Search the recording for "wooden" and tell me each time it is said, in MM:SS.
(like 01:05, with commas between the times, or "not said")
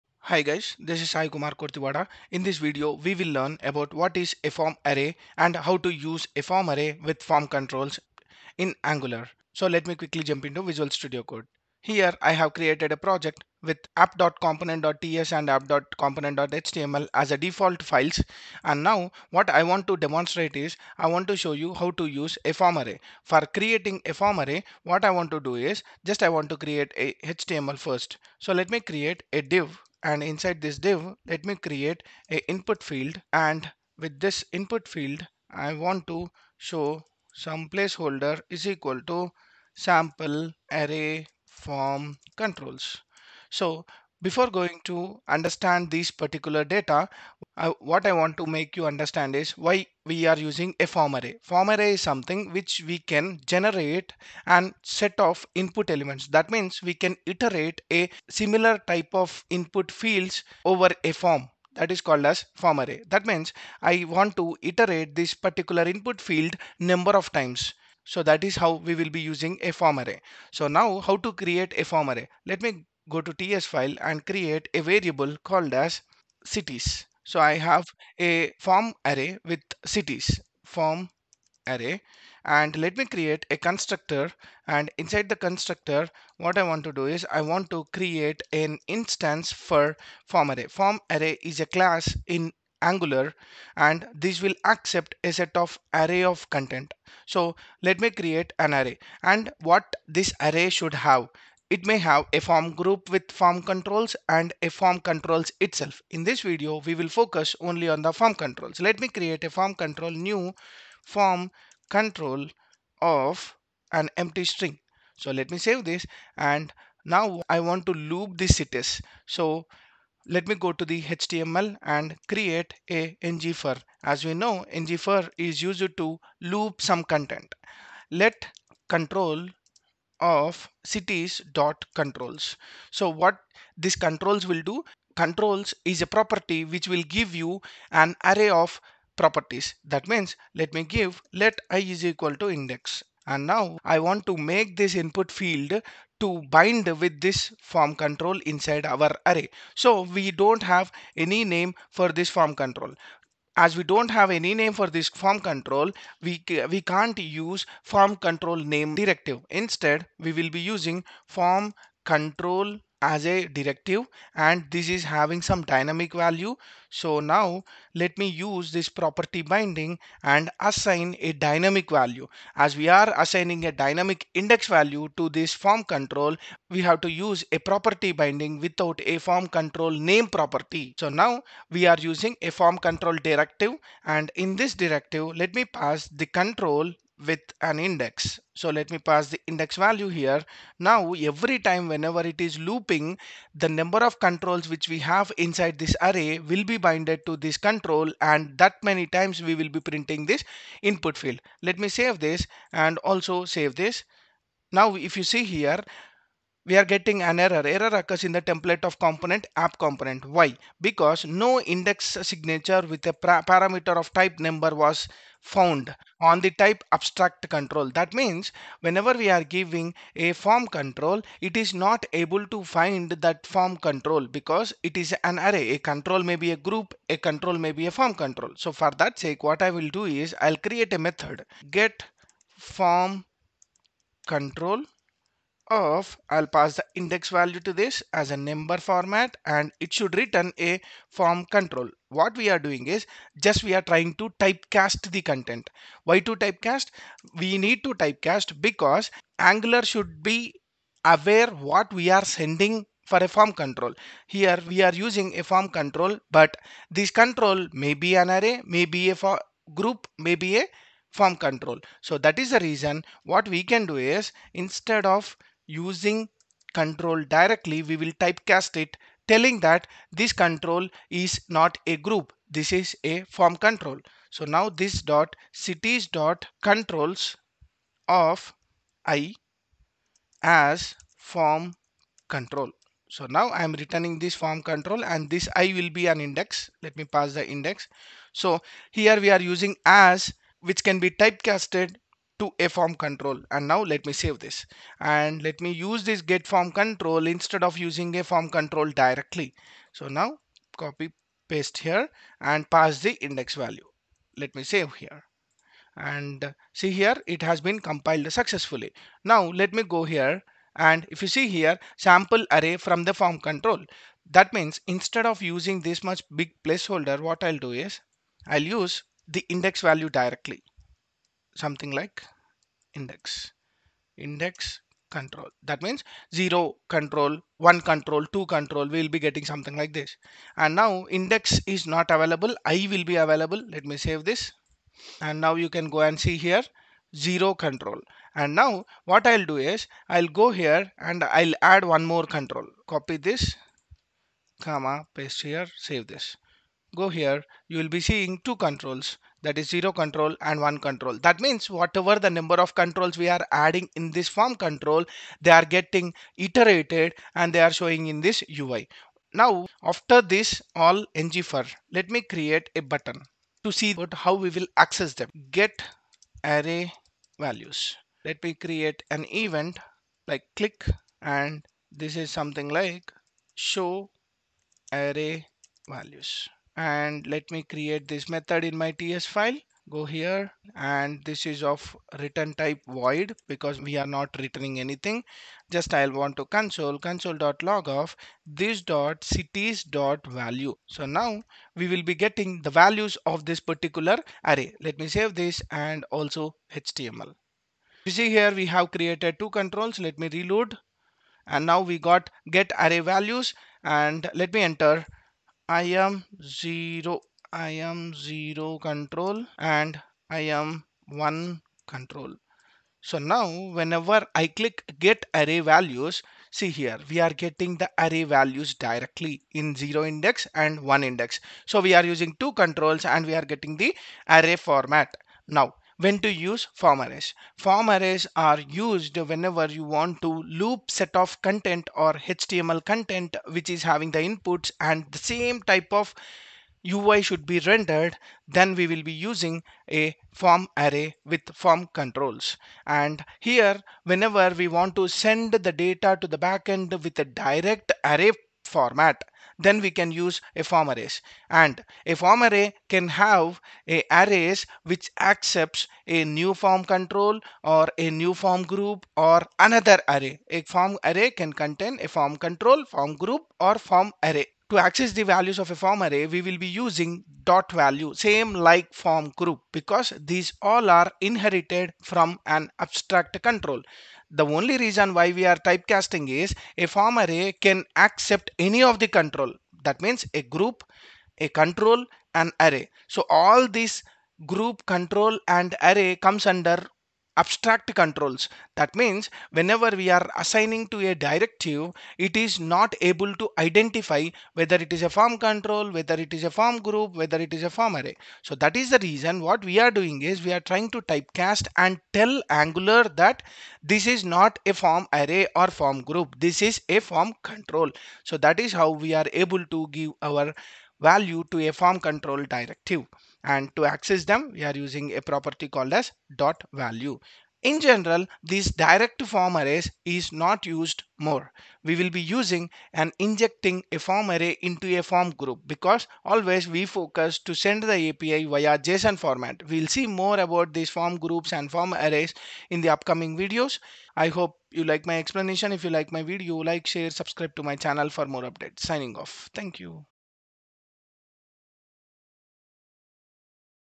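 not said.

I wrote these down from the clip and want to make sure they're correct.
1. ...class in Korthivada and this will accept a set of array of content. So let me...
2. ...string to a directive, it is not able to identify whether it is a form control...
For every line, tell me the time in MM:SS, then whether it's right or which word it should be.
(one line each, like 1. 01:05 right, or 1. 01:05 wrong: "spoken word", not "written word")
1. 01:31 wrong: "Angular", not "Korthivada"
2. 08:10 wrong: "assigning", not "string".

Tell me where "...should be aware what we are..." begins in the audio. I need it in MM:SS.
04:09.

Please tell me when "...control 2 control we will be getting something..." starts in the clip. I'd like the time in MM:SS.
05:27.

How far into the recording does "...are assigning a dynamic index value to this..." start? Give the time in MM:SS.
02:52.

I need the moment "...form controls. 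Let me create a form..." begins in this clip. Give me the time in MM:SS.
01:48.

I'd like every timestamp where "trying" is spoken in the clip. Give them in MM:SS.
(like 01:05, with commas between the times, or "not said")
04:03, 08:20.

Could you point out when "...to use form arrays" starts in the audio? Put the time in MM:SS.
07:06.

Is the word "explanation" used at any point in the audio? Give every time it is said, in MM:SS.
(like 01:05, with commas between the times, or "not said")
08:55.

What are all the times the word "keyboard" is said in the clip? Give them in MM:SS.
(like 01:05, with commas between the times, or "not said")
not said.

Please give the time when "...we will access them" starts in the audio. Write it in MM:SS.
06:04.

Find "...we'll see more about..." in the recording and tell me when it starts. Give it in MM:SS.
08:49.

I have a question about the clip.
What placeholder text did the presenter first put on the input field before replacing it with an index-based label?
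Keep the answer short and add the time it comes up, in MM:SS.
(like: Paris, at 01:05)
sample array form controls, at 00:39.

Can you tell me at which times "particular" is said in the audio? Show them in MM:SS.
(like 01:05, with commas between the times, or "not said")
00:46, 01:05, 06:33.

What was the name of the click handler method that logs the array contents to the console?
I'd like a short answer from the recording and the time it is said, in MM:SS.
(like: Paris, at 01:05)
show array values, at 06:13.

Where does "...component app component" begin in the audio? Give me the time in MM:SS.
03:28.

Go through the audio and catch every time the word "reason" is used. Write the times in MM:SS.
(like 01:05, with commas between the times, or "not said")
04:22, 07:54, 08:18.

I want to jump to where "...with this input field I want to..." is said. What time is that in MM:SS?
00:33.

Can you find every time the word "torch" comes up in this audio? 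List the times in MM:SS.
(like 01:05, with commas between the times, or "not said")
not said.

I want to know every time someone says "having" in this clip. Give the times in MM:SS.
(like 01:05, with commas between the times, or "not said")
02:45, 07:13.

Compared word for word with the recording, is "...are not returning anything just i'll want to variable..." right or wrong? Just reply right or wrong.
wrong.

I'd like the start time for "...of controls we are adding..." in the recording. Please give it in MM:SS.
05:52.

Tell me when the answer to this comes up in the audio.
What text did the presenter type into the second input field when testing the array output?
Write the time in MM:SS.
06:50.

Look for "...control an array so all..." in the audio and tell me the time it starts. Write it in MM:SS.
08:01.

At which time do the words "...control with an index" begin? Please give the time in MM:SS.
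03:06.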